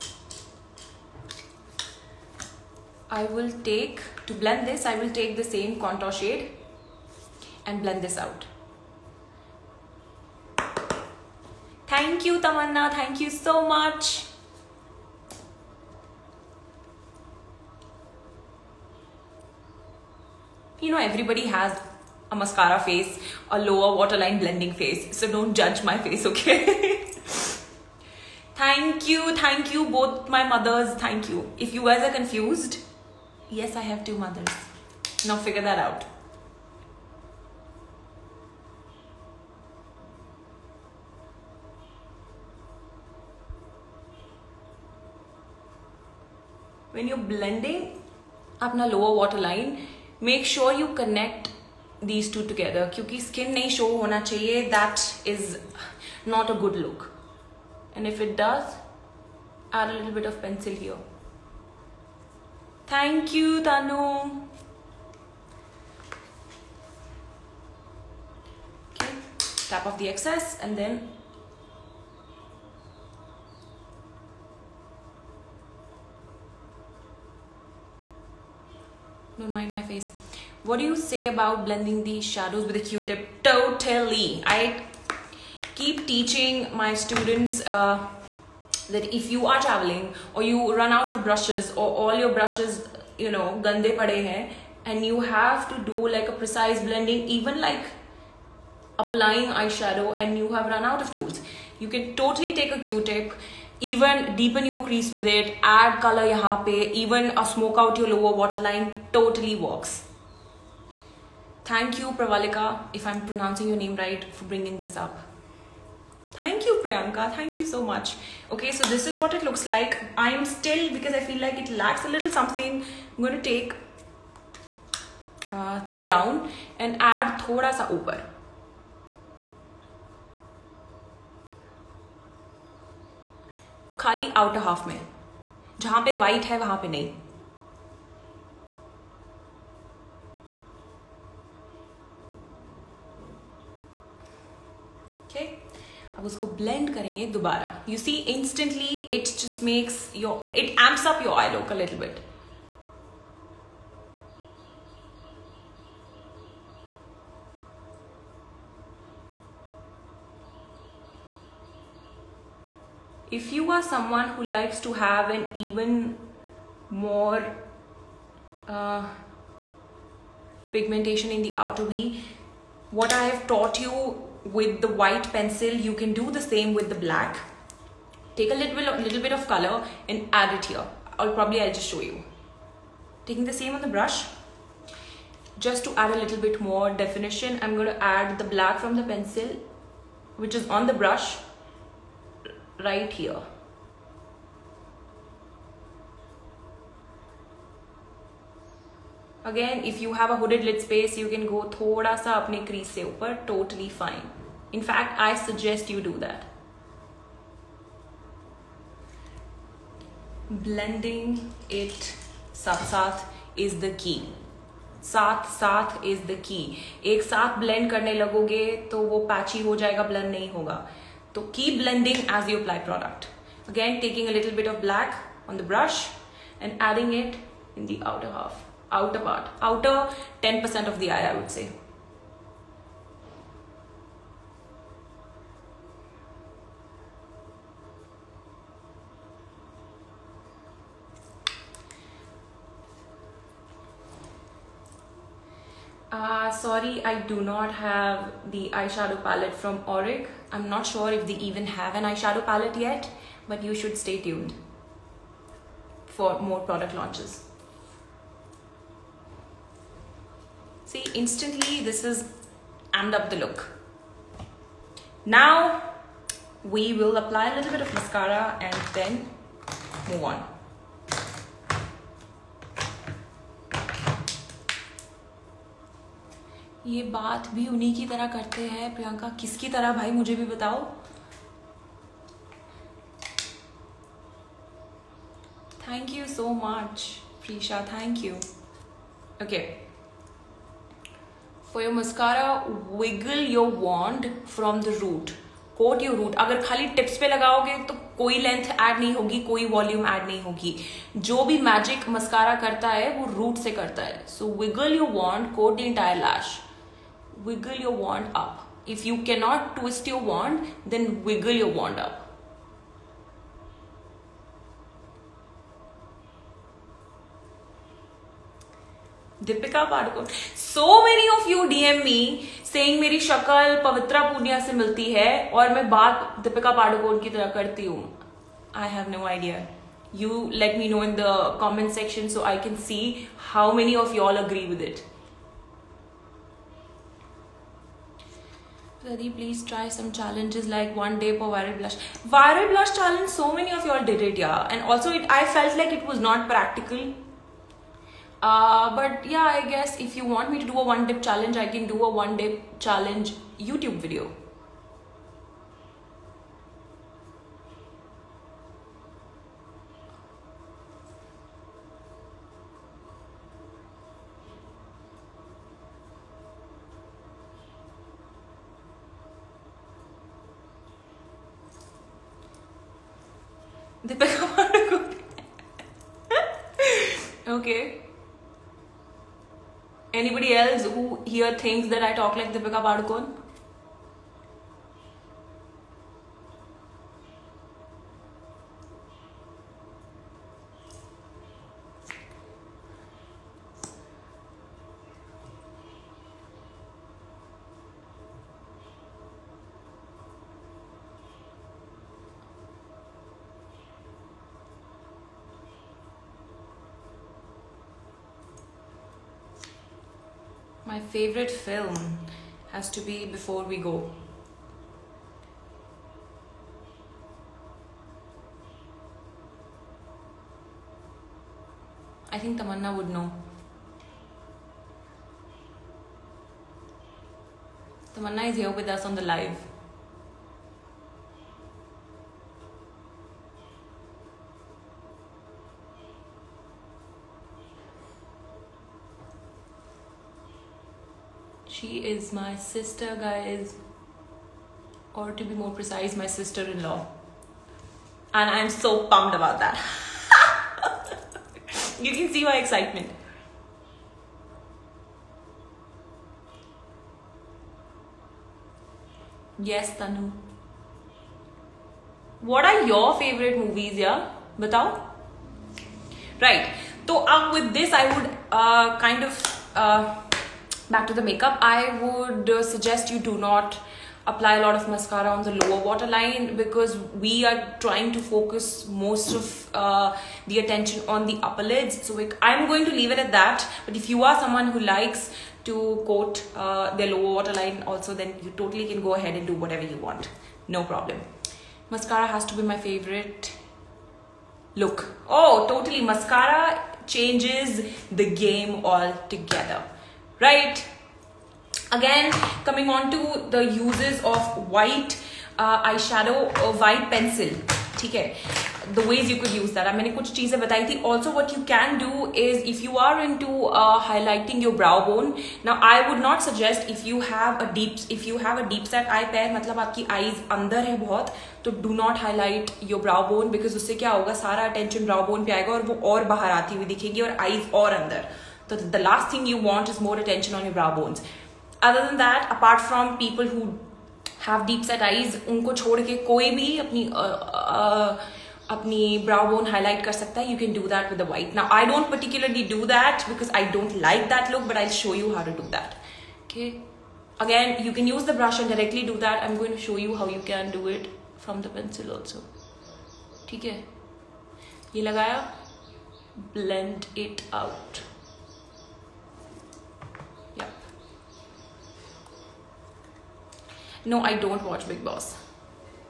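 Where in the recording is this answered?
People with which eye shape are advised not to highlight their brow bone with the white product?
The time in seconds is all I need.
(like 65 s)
534 s.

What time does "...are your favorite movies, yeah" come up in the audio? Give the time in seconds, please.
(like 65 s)
462 s.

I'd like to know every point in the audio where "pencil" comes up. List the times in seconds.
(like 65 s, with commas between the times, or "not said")
175 s, 189 s, 507 s.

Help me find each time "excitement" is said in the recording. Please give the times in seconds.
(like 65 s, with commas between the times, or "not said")
452 s.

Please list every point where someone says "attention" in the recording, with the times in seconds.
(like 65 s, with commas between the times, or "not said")
480 s, 530 s.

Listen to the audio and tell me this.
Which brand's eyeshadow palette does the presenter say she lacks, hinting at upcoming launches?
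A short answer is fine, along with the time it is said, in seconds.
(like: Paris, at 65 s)
Auric, at 249 s.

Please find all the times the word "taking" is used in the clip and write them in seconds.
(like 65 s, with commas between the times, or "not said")
183 s, 224 s.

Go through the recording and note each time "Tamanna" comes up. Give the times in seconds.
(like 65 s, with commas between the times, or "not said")
12 s, 422 s, 428 s.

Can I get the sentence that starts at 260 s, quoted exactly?
See, instantly this is amped up the look.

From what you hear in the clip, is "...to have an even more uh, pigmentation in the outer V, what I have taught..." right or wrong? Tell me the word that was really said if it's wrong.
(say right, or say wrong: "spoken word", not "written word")
right.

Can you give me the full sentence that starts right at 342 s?
Viral blush challenge, so many of y'all did it, yeah.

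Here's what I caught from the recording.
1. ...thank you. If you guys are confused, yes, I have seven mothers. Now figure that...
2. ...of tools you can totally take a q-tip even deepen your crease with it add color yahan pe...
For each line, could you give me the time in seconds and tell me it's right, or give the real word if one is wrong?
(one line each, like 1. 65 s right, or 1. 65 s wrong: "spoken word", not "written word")
1. 30 s wrong: "two", not "seven"
2. 101 s right.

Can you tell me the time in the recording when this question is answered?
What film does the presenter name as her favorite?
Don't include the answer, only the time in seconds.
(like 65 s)
413 s.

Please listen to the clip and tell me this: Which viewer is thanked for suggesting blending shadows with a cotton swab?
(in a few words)
Pravalika.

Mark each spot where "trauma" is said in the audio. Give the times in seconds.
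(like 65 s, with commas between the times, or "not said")
not said.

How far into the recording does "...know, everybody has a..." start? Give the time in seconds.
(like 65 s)
20 s.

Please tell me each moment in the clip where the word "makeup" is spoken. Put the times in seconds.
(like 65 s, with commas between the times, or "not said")
471 s.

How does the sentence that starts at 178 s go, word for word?
Take a little bit, of, little bit of color and add it here.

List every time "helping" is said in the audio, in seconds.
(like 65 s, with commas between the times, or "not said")
not said.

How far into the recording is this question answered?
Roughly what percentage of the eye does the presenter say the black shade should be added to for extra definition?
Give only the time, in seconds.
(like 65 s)
230 s.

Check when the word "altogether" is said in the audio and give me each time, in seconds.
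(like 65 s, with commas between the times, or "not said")
498 s.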